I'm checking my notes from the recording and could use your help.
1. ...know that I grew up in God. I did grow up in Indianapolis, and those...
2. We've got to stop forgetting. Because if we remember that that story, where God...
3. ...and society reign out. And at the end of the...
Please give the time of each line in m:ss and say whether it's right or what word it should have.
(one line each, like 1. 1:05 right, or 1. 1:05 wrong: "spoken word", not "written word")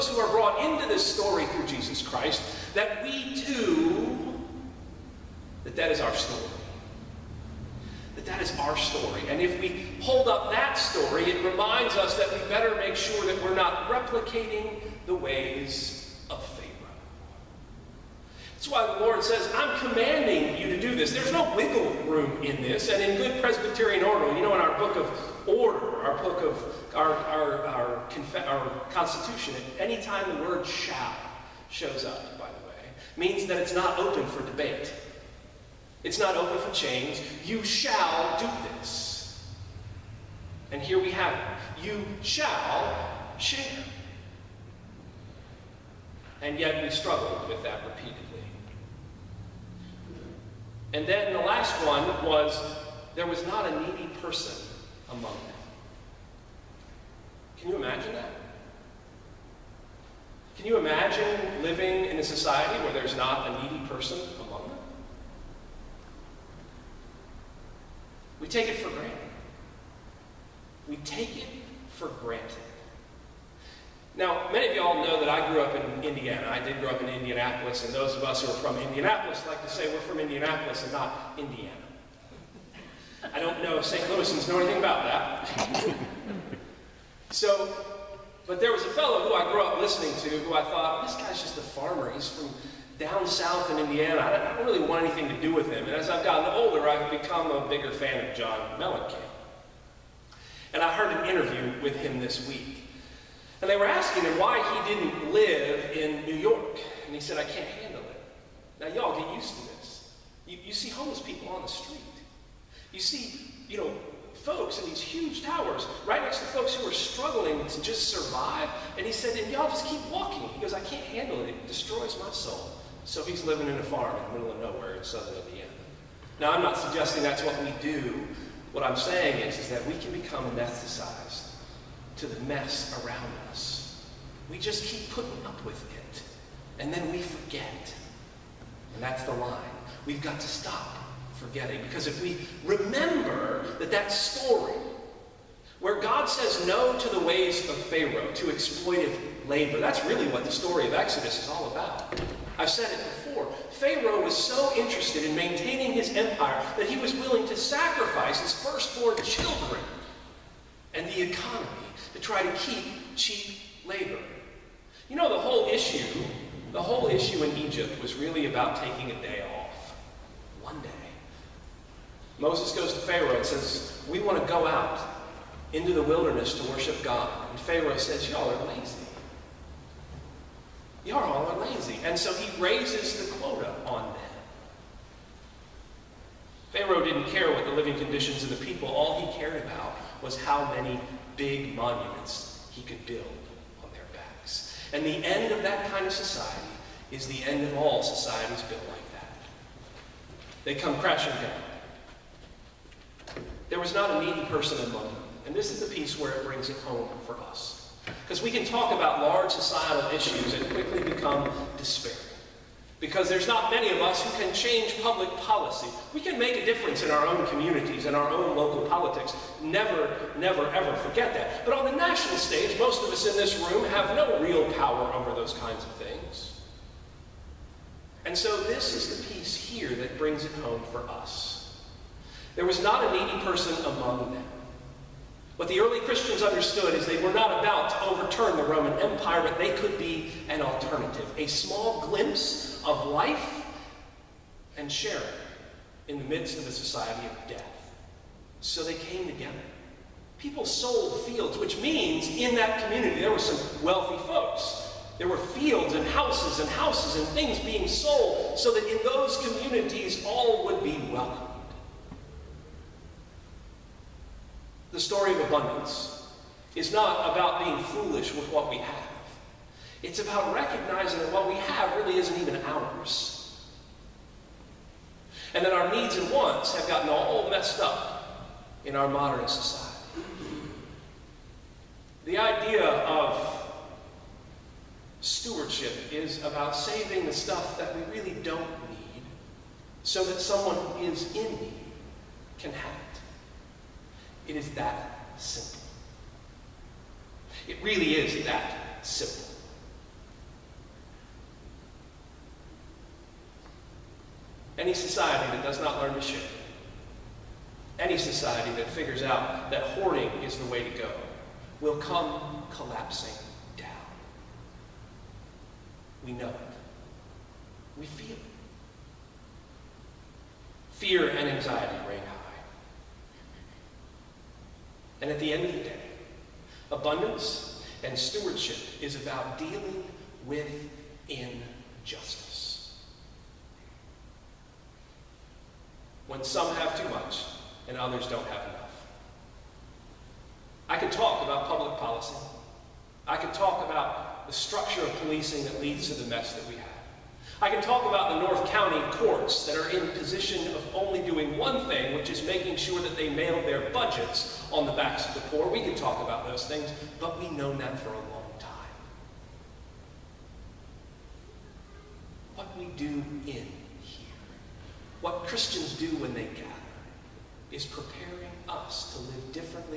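1. 1:15 wrong: "Indiana", not "God"
2. 2:20 right
3. 5:21 wrong: "anxiety", not "society".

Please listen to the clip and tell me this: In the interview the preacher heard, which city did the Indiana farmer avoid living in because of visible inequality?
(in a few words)
New York.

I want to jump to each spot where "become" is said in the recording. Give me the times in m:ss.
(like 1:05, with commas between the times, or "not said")
1:37, 2:10, 3:31.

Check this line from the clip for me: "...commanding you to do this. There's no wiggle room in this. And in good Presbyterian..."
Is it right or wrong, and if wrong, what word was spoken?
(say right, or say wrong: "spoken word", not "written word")
right.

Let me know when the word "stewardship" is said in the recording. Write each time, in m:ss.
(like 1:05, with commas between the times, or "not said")
4:45, 5:28.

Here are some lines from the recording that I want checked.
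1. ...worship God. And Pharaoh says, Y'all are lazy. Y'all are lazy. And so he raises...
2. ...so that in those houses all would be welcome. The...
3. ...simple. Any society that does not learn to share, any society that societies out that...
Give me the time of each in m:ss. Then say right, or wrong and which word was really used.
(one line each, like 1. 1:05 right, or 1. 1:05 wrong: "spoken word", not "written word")
1. 2:56 right
2. 4:18 wrong: "communities", not "houses"
3. 4:59 wrong: "figures", not "societies".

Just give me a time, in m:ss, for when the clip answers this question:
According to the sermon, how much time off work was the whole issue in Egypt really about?
2:50.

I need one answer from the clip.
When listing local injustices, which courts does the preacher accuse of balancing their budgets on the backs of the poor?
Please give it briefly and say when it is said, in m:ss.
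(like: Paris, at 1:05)
North County courts, at 5:48.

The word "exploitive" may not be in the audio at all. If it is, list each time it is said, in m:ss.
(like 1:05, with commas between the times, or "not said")
2:28.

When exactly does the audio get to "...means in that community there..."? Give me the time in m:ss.
4:11.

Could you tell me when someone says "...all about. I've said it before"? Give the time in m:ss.
2:31.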